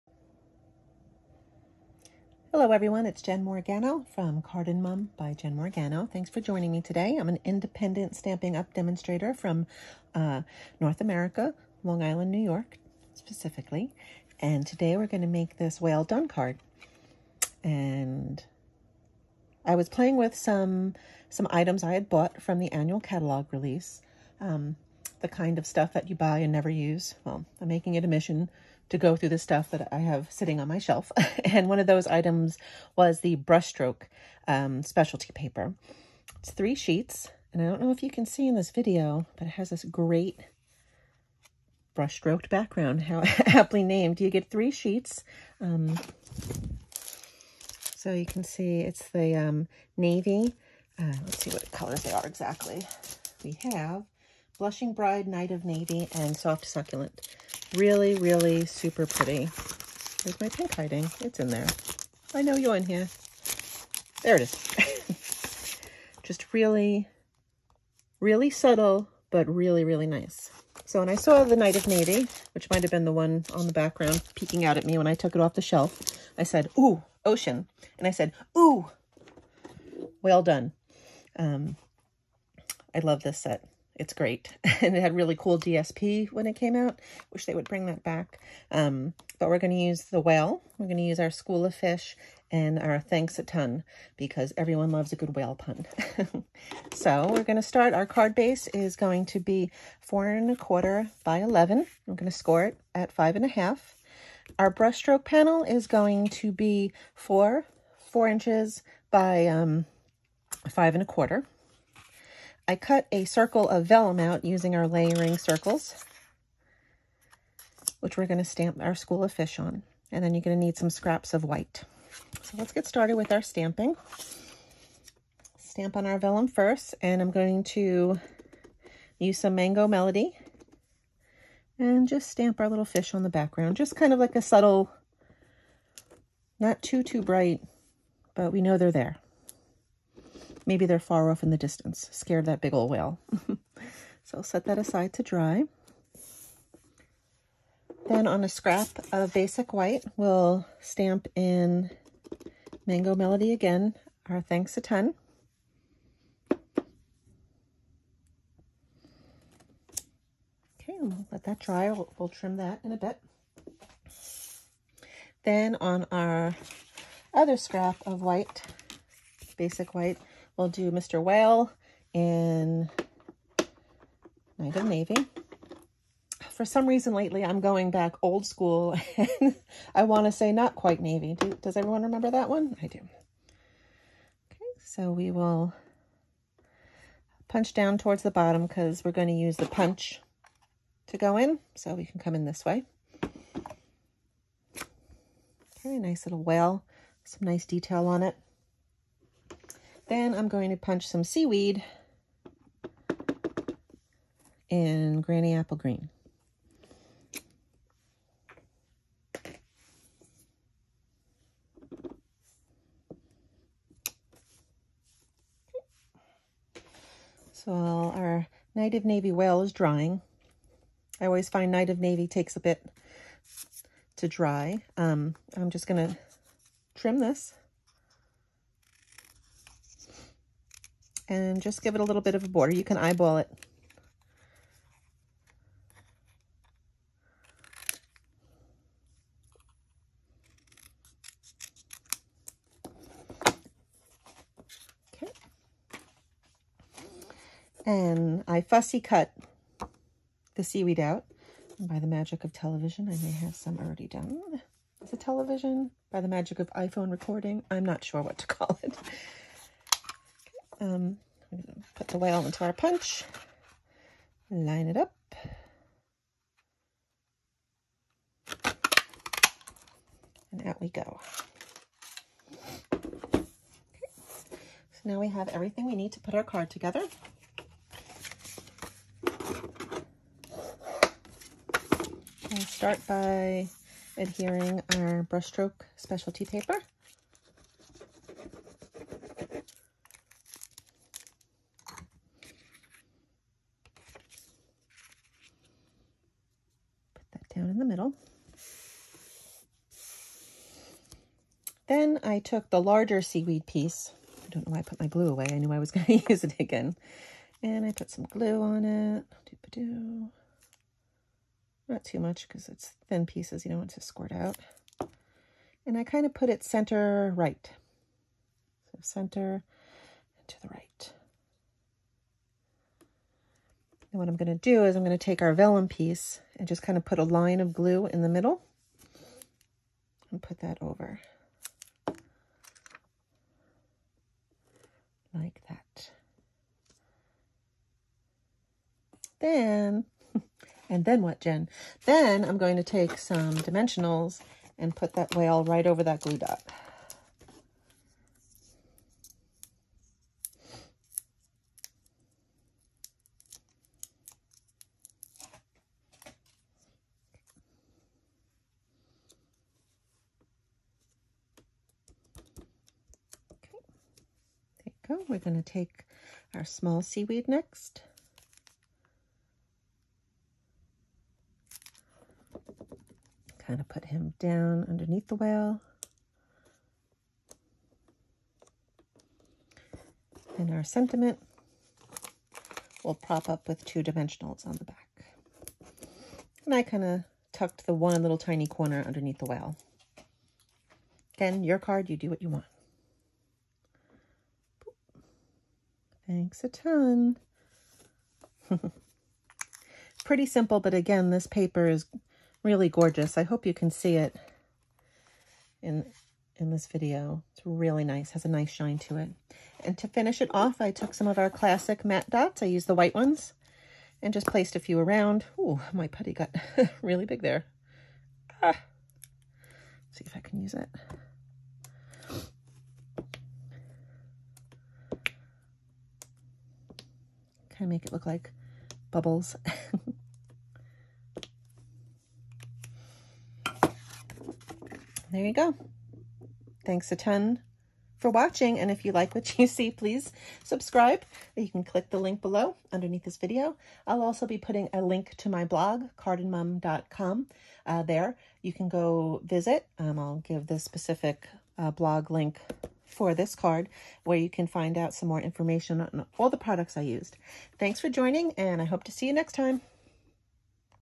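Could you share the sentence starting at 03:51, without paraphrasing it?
and just give it a little bit of a border.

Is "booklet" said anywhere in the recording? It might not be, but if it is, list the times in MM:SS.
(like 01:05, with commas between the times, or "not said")
not said.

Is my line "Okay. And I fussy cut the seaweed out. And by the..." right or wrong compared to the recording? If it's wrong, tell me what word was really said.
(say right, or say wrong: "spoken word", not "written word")
right.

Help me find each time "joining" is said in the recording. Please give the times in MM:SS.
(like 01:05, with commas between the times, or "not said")
00:06, 07:38.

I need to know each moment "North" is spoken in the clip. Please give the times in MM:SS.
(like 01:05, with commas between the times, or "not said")
00:10.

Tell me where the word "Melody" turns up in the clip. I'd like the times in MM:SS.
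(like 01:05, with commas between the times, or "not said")
02:09, 02:33.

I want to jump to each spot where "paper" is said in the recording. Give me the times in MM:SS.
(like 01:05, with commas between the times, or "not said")
00:35, 04:46, 06:41.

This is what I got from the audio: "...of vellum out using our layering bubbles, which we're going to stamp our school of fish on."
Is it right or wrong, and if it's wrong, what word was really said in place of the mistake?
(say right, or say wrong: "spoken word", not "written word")
wrong: "circles", not "bubbles".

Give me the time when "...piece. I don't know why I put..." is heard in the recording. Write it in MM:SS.
05:03.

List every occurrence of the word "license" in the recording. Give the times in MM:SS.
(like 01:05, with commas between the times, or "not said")
not said.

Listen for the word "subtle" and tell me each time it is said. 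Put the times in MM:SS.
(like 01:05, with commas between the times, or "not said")
01:08, 02:14.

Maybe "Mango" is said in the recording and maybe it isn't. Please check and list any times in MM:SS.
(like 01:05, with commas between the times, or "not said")
02:09, 02:32.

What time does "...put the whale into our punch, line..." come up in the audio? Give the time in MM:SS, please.
04:21.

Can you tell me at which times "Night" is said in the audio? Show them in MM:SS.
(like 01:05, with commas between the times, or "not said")
00:55, 01:11, 02:54.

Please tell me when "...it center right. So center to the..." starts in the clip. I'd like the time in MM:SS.
05:16.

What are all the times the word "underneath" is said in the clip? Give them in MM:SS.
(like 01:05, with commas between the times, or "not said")
06:14, 06:29, 07:22.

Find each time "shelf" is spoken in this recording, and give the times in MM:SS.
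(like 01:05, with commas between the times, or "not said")
00:30, 01:15.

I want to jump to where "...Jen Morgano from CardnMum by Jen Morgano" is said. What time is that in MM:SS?
00:03.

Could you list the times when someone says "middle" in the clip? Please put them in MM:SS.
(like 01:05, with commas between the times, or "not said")
04:57, 05:28.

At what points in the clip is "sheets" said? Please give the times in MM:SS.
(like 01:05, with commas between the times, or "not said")
00:36, 00:44.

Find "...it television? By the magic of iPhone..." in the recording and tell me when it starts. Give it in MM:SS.
04:15.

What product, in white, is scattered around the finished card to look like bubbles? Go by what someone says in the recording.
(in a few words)
classic matte dots.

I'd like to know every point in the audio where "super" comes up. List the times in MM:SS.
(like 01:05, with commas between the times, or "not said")
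00:58.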